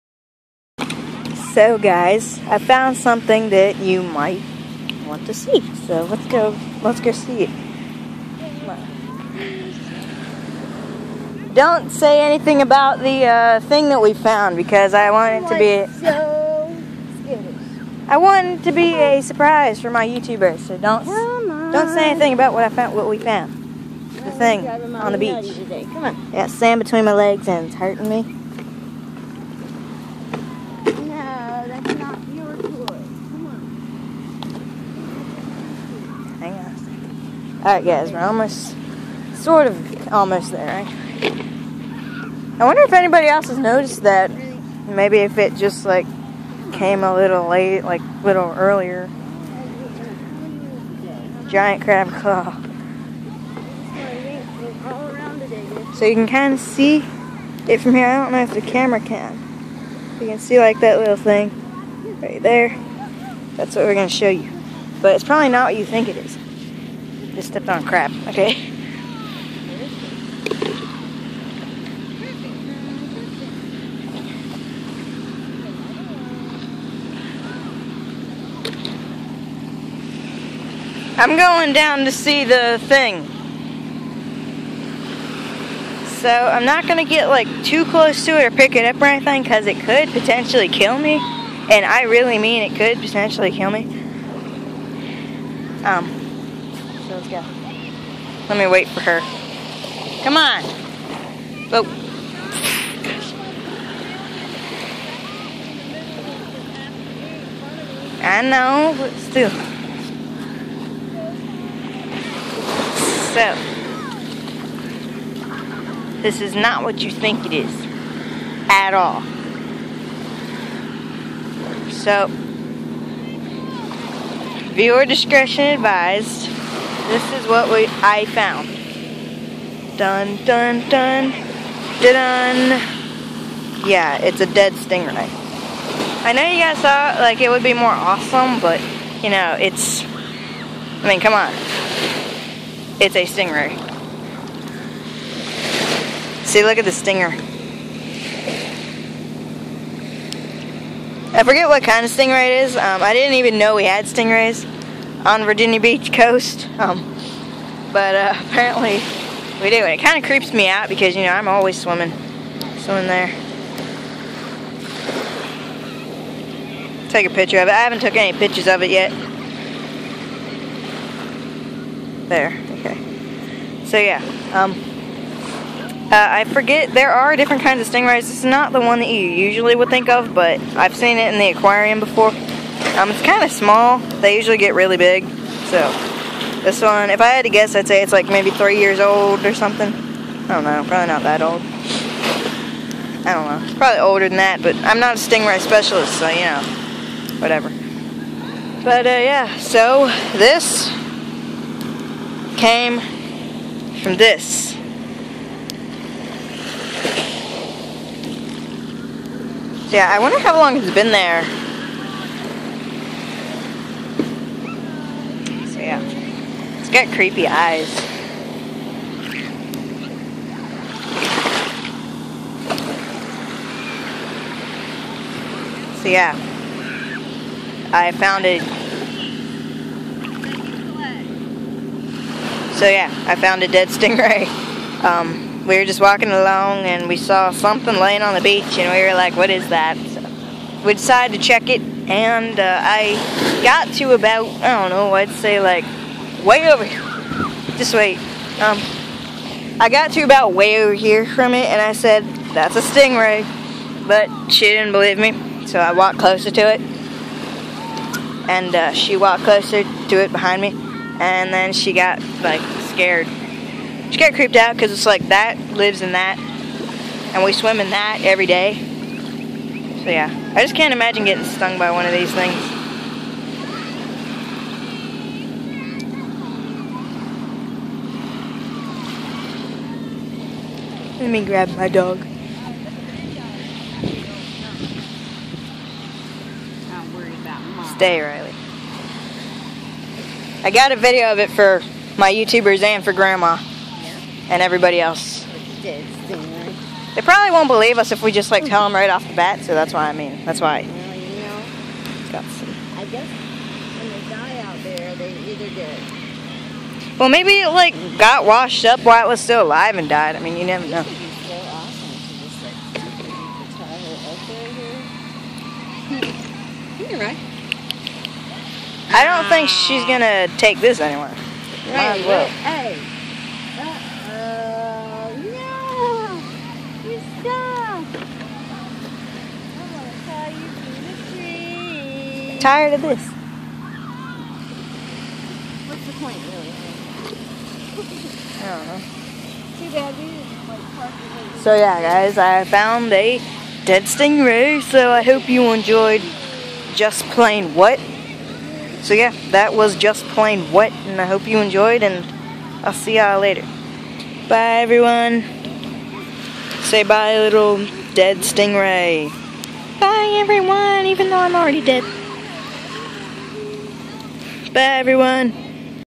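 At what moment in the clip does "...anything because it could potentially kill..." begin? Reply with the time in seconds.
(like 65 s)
89 s.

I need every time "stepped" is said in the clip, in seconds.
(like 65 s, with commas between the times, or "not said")
67 s.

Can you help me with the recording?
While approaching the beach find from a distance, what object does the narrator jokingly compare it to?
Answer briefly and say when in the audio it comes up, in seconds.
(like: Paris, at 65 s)
Giant crab claw, at 51 s.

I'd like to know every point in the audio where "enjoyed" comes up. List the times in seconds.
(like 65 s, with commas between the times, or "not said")
345 s, 351 s.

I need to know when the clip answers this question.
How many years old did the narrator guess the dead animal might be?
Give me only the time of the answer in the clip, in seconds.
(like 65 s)
188 s.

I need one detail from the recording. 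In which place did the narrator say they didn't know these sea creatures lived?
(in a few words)
Virginia Beach.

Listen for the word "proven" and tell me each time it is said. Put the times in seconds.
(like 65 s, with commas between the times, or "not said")
not said.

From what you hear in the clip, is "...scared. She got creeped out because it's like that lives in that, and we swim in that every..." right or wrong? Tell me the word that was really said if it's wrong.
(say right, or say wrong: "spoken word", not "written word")
right.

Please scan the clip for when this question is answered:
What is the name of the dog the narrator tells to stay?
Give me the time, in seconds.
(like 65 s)
288 s.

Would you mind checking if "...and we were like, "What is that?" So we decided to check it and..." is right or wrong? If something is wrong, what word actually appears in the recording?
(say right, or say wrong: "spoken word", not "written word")
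right.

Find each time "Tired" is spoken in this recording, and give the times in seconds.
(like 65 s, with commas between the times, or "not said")
332 s.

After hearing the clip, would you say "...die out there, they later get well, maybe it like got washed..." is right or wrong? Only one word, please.
wrong.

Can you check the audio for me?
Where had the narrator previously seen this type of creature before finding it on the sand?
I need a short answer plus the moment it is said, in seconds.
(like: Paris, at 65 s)
The aquarium, at 181 s.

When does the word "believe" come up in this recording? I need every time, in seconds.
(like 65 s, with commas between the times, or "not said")
254 s, 297 s.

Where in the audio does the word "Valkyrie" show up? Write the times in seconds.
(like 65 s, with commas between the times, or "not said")
not said.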